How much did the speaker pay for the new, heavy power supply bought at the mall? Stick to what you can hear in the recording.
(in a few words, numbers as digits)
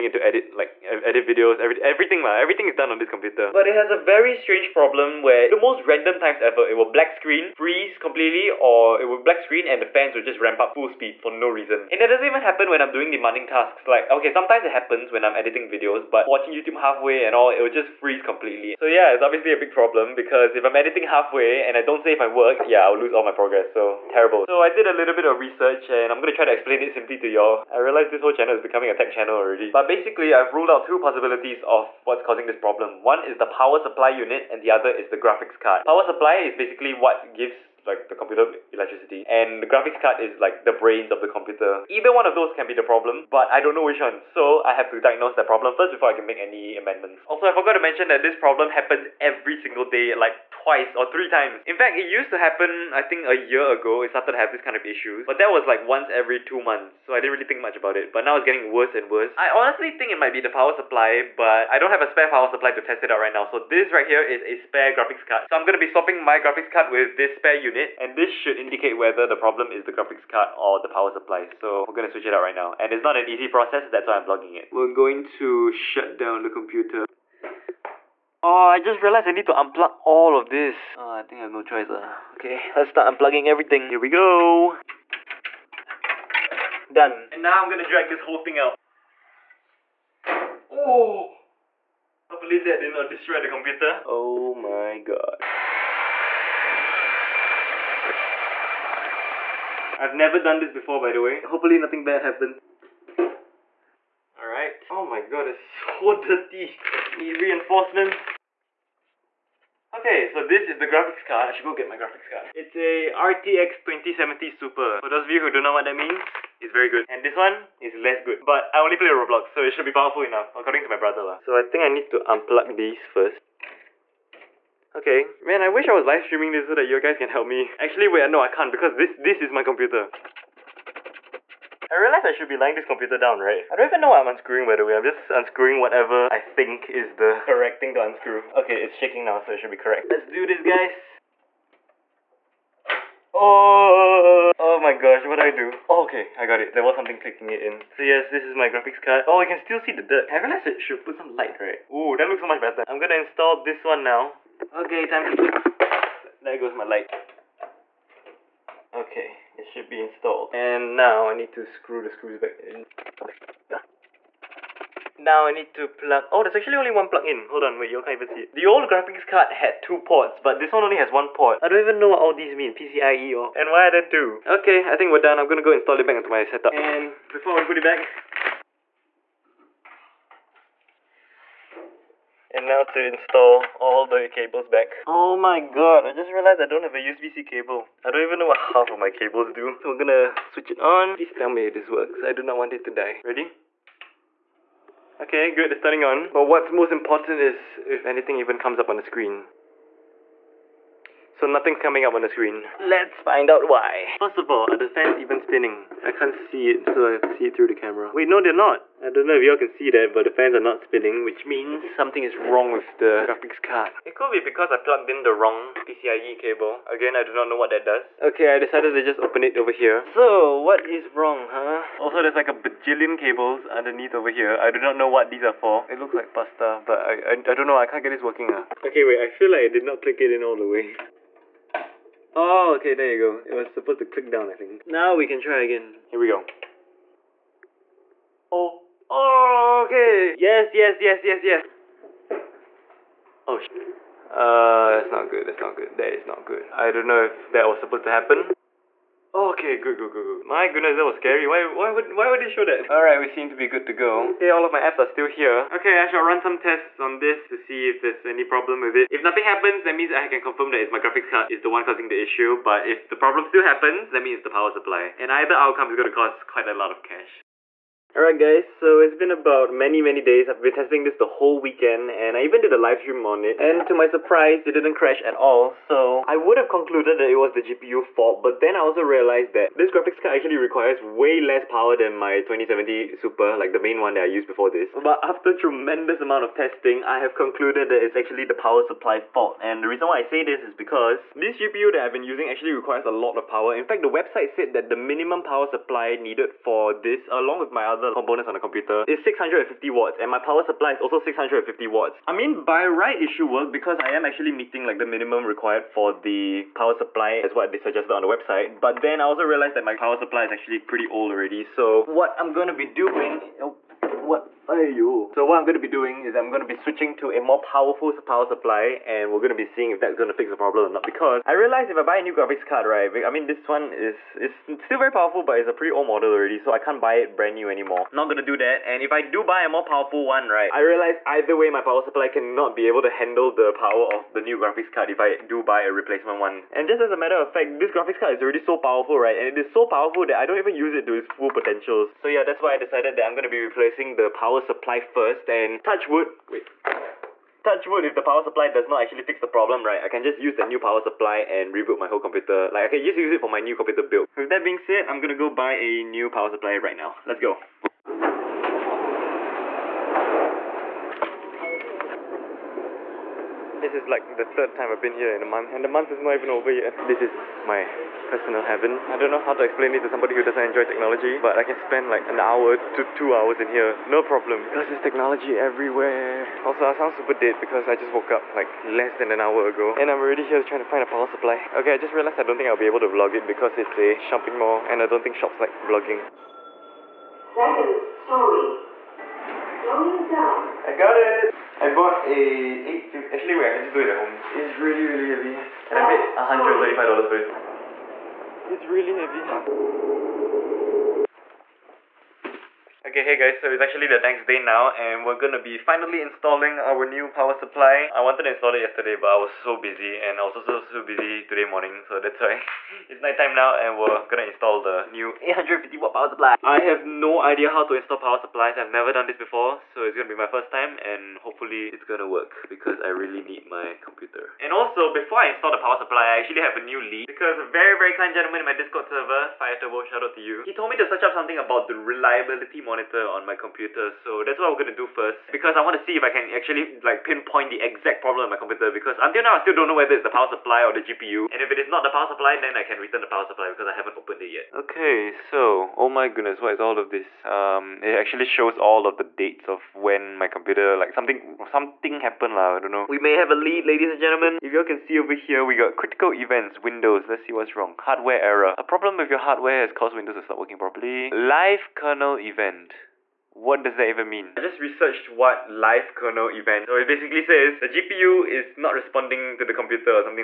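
$135.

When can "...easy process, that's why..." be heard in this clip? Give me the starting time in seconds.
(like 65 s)
73 s.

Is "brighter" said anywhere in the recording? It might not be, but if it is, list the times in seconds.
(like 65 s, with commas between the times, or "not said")
not said.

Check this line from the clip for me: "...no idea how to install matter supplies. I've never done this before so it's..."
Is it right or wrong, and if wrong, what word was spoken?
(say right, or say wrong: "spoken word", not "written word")
wrong: "power", not "matter".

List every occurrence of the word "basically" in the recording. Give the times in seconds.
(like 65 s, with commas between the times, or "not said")
29 s, 36 s, 467 s.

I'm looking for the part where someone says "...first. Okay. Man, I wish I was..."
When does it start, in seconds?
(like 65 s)
123 s.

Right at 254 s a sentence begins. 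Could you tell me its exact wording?
Okay, all of my apps are still here.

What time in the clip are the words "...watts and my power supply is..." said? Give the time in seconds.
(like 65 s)
299 s.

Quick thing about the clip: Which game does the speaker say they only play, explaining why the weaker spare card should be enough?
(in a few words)
Roblox.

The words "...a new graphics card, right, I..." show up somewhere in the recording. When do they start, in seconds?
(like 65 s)
322 s.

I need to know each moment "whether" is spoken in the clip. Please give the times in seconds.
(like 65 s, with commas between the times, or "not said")
68 s, 439 s.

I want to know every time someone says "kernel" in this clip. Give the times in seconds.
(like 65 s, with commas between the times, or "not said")
461 s, 466 s.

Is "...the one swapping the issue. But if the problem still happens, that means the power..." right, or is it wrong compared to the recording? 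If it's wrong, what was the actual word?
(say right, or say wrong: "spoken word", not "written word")
wrong: "causing", not "swapping".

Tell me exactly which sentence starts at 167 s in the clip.
Hold on, wait, you can't even see it.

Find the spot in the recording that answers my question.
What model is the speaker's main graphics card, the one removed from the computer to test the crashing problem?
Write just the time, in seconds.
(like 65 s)
113 s.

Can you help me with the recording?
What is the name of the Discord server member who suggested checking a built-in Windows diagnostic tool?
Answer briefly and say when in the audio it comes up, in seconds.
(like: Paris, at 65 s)
Fire Turbo, at 429 s.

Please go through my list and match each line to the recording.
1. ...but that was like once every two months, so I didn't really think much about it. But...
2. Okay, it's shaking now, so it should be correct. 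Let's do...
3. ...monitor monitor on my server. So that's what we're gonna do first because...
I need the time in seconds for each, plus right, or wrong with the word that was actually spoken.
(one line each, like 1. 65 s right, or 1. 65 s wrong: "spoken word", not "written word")
1. 55 s right
2. 138 s right
3. 432 s wrong: "computer", not "server".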